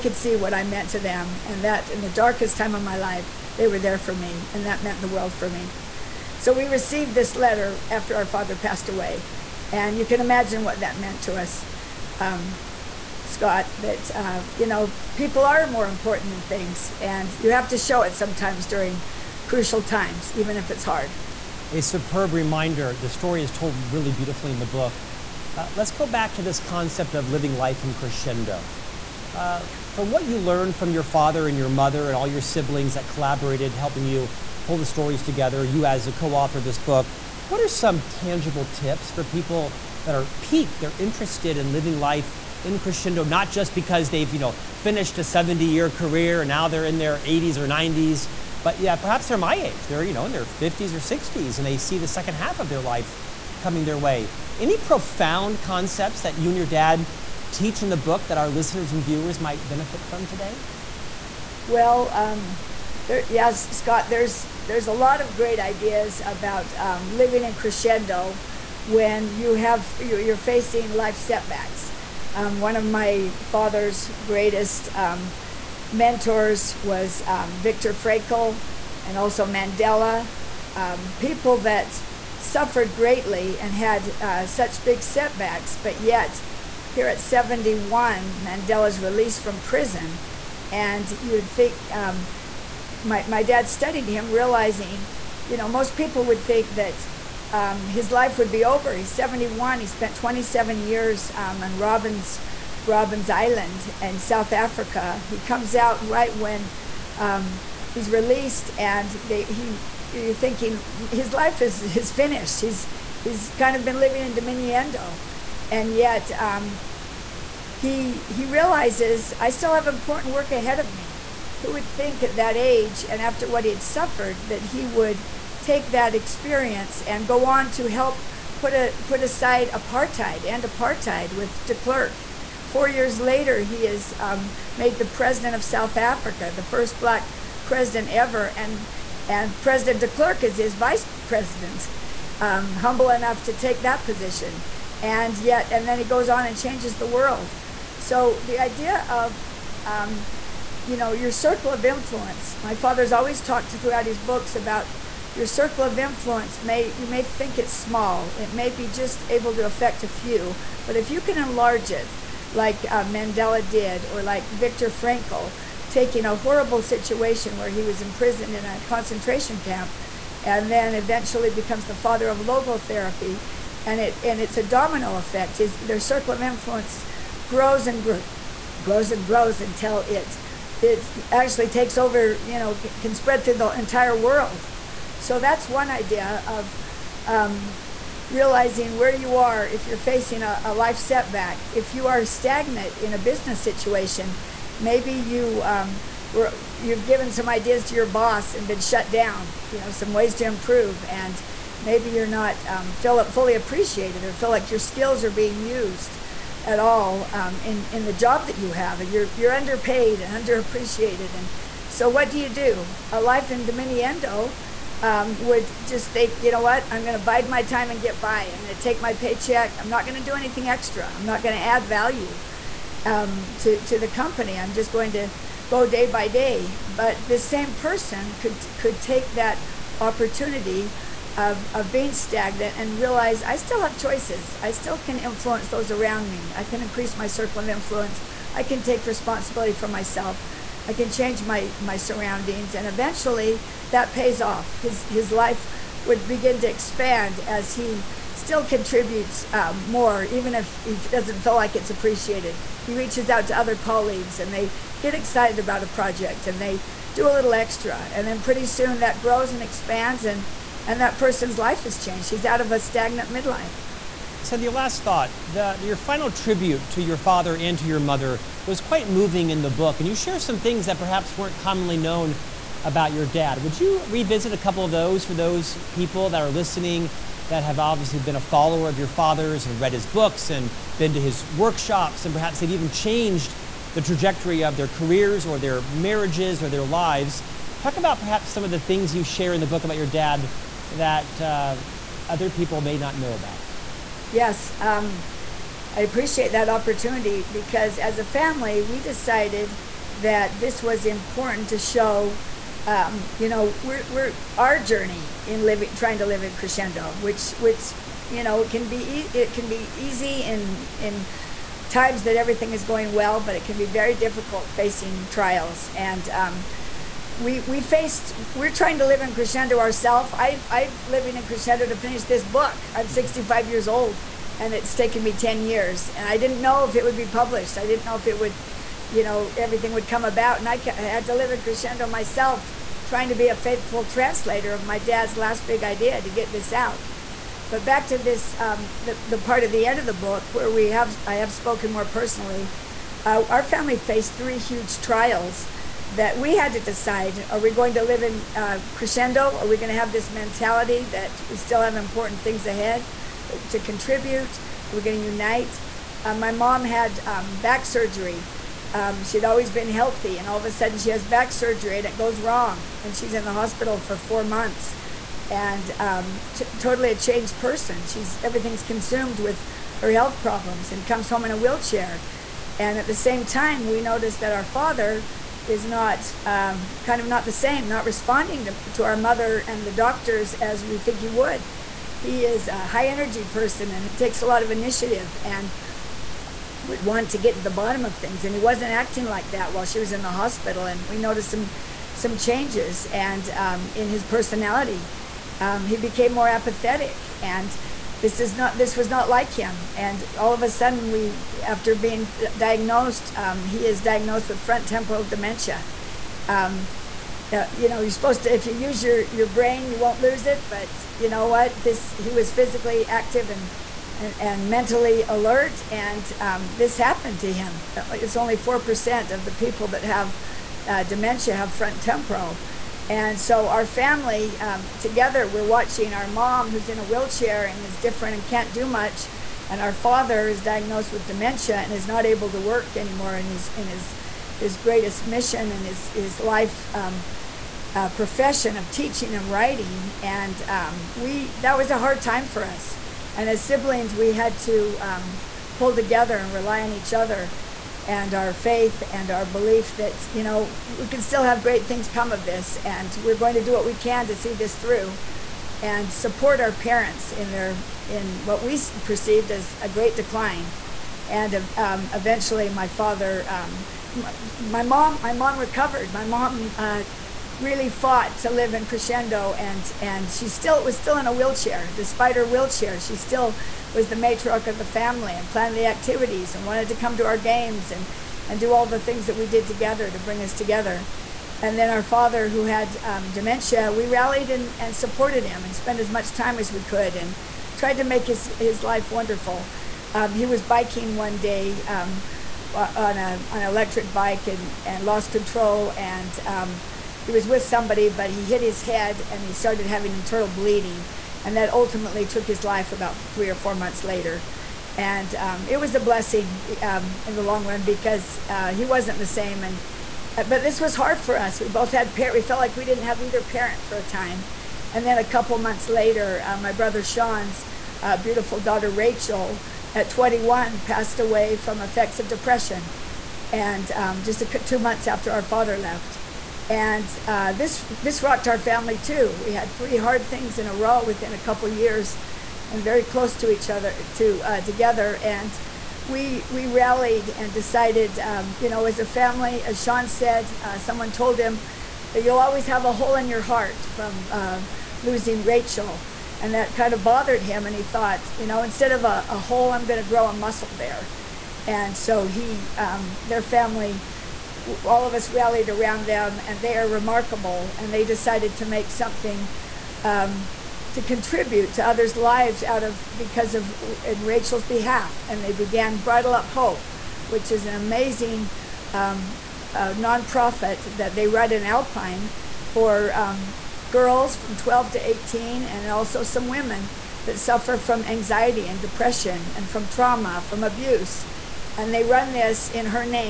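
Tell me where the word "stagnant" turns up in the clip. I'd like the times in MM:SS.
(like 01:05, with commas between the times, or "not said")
03:12, 03:52, 04:22.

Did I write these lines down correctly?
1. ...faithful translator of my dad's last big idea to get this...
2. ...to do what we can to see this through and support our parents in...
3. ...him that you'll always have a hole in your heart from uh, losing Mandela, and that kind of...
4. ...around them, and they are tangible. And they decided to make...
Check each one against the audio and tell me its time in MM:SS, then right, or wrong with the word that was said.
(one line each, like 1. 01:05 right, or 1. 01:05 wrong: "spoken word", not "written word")
1. 05:33 right
2. 07:33 right
3. 09:01 wrong: "Rachel", not "Mandela"
4. 09:15 wrong: "remarkable", not "tangible".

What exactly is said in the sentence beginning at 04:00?
I can change my my surroundings and eventually that pays off.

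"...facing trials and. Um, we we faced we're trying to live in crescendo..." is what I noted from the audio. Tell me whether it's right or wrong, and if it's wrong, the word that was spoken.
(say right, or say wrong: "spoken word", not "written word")
right.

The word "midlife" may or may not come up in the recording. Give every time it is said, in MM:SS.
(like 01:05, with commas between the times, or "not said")
04:23.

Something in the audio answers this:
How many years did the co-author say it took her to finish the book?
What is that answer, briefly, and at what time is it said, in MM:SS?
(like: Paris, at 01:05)
10, at 05:25.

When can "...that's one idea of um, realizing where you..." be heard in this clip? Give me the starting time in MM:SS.
03:05.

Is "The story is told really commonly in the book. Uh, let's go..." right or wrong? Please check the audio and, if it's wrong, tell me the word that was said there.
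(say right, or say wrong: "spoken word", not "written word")
wrong: "beautifully", not "commonly".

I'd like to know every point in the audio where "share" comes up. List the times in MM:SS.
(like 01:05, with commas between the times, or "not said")
04:30, 04:49.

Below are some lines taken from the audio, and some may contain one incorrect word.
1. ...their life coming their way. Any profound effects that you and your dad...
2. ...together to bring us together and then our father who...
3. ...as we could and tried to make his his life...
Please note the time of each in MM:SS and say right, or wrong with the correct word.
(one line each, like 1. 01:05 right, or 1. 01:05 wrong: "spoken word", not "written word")
1. 00:52 wrong: "concepts", not "effects"
2. 07:59 right
3. 08:06 right.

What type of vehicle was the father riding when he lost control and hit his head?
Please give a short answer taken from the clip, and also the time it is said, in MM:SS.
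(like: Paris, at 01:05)
electric bike, at 08:13.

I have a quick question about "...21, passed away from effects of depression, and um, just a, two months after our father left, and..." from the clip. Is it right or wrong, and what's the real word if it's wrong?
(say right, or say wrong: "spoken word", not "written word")
right.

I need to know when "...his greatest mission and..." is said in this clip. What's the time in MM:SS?
07:14.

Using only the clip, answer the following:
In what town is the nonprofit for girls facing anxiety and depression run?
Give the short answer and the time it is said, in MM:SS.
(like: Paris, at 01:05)
Alpine, at 09:31.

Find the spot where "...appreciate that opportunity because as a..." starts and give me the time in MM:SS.
04:56.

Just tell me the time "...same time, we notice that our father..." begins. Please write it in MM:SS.
06:13.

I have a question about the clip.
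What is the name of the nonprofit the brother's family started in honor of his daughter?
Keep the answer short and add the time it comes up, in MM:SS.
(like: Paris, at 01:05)
Bridle Up Hope, at 09:25.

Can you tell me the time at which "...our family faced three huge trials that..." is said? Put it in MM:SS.
05:43.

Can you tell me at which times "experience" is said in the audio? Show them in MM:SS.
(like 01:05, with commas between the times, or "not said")
02:06.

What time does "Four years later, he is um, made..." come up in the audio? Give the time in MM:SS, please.
02:12.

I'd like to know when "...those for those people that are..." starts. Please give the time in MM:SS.
04:34.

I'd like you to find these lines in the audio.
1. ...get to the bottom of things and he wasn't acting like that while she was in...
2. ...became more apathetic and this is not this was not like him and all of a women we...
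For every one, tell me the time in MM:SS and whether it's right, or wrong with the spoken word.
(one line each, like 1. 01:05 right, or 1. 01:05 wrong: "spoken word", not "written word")
1. 06:27 right
2. 06:35 wrong: "sudden", not "women".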